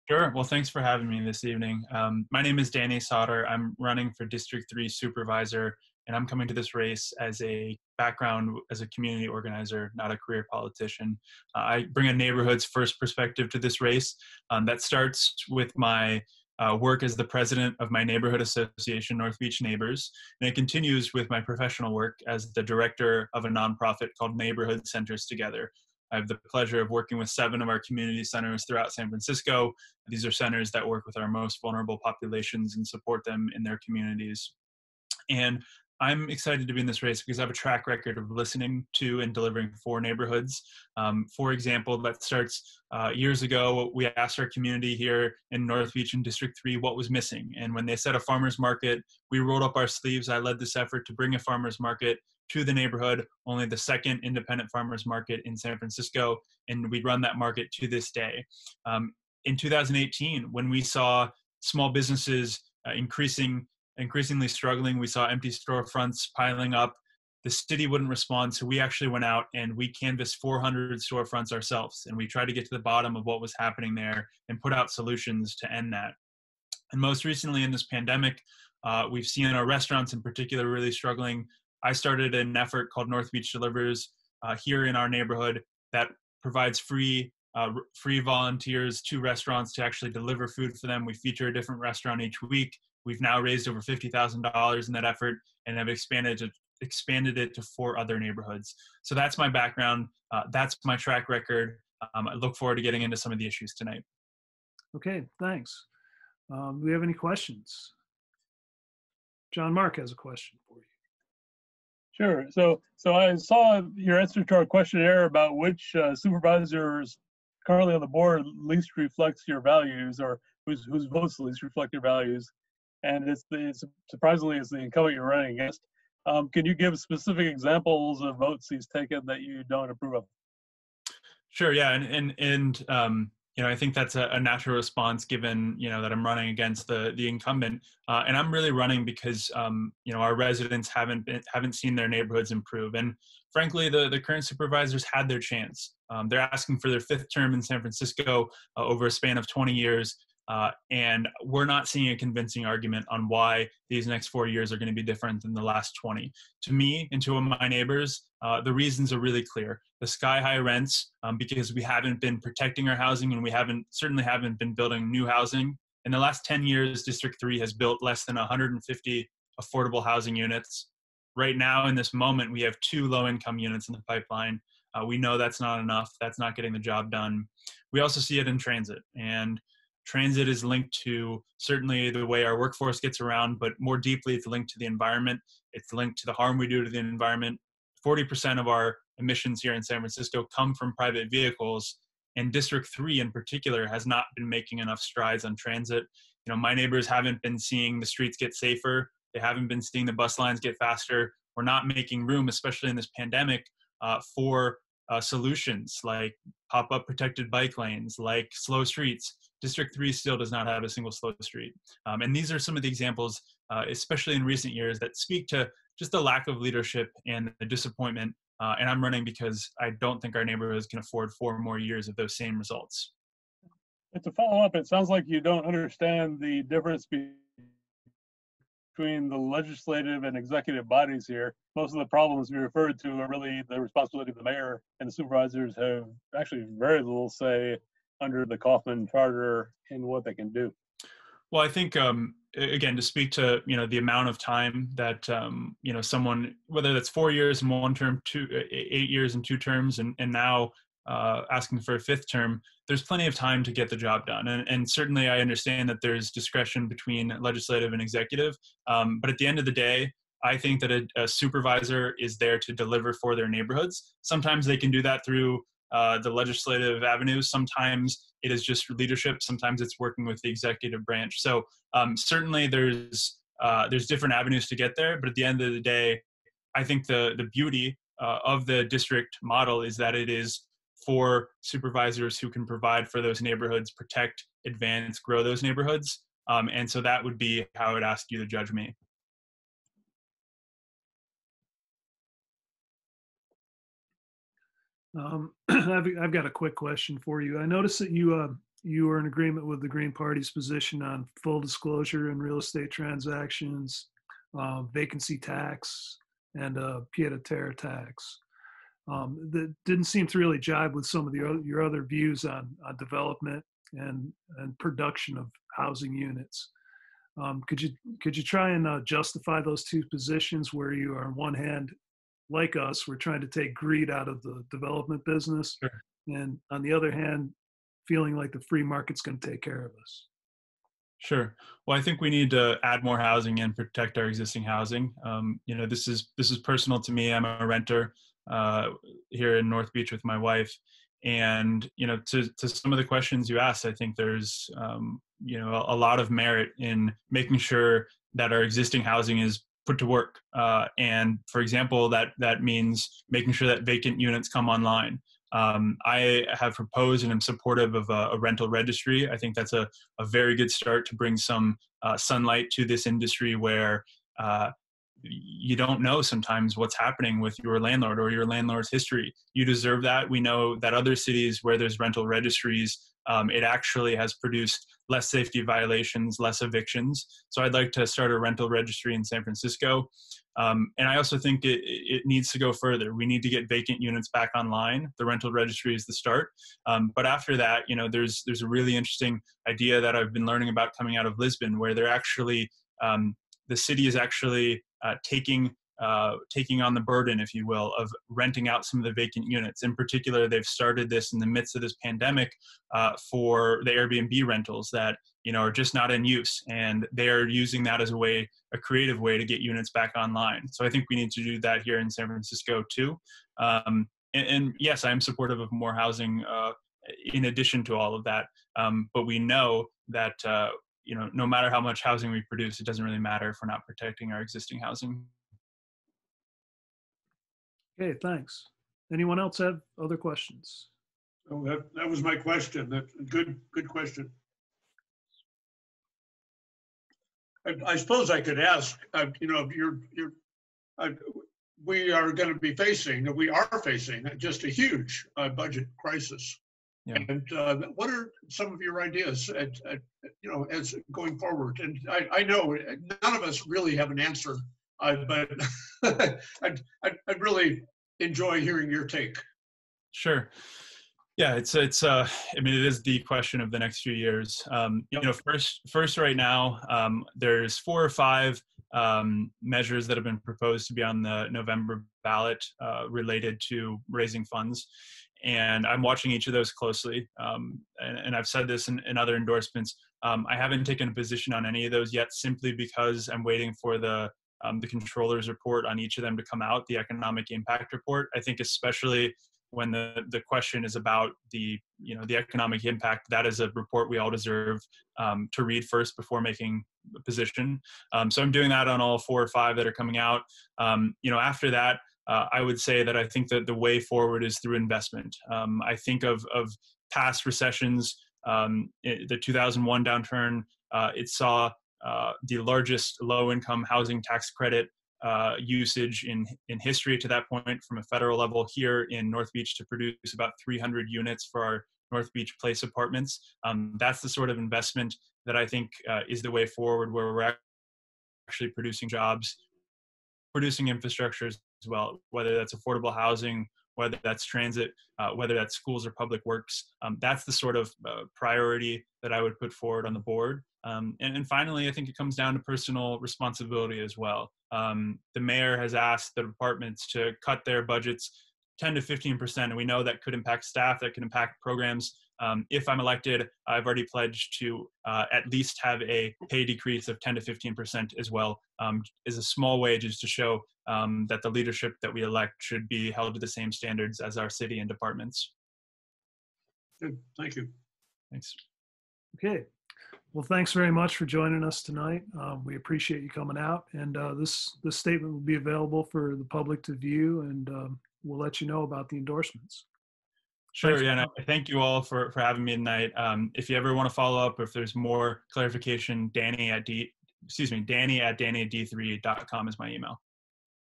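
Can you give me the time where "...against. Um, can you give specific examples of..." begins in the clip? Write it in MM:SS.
02:05.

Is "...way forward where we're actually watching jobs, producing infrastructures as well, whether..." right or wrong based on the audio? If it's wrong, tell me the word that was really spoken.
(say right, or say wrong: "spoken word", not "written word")
wrong: "producing", not "watching".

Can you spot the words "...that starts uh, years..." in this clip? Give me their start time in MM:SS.
00:41.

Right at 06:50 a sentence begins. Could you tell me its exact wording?
So I think we need to do that here in San Francisco too.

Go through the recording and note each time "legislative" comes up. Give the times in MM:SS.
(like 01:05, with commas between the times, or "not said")
03:49, 04:17, 04:26.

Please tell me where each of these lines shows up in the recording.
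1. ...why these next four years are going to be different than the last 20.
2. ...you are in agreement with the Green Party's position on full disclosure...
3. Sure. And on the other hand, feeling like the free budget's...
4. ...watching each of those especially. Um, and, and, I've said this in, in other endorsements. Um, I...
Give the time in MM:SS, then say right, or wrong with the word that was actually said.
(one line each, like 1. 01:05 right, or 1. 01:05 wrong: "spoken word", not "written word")
1. 02:33 right
2. 04:58 right
3. 05:25 wrong: "market", not "budget"
4. 07:56 wrong: "closely", not "especially".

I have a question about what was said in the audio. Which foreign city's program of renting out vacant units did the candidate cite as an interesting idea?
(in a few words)
Lisbon.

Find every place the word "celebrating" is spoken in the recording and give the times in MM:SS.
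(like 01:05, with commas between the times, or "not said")
not said.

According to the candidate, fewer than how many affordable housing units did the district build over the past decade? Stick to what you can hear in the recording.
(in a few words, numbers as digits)
150.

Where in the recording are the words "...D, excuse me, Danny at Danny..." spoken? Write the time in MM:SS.
09:46.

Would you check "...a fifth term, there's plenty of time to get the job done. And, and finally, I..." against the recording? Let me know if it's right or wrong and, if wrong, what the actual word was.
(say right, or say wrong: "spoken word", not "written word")
wrong: "certainly", not "finally".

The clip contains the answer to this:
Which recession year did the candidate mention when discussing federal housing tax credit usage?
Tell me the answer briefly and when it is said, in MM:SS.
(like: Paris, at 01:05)
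2001, at 08:29.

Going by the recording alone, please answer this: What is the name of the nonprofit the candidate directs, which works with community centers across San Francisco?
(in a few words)
Neighborhood Centers Together.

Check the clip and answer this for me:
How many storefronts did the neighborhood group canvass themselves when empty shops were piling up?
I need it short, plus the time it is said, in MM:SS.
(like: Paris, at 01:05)
400, at 01:10.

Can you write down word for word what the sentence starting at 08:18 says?
Um, so I'm doing that on all four or five that are coming out.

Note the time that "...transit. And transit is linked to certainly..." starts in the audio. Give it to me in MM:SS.
02:58.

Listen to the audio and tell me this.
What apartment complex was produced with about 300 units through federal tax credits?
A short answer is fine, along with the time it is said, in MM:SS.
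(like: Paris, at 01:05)
North Beach Place, at 08:42.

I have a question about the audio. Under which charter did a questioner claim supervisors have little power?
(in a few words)
Kaufman Charter.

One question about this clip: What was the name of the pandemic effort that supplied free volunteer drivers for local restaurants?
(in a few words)
North Beach Delivers.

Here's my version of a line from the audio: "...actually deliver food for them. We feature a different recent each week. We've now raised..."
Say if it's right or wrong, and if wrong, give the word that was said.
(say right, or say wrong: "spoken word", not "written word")
wrong: "restaurant", not "recent".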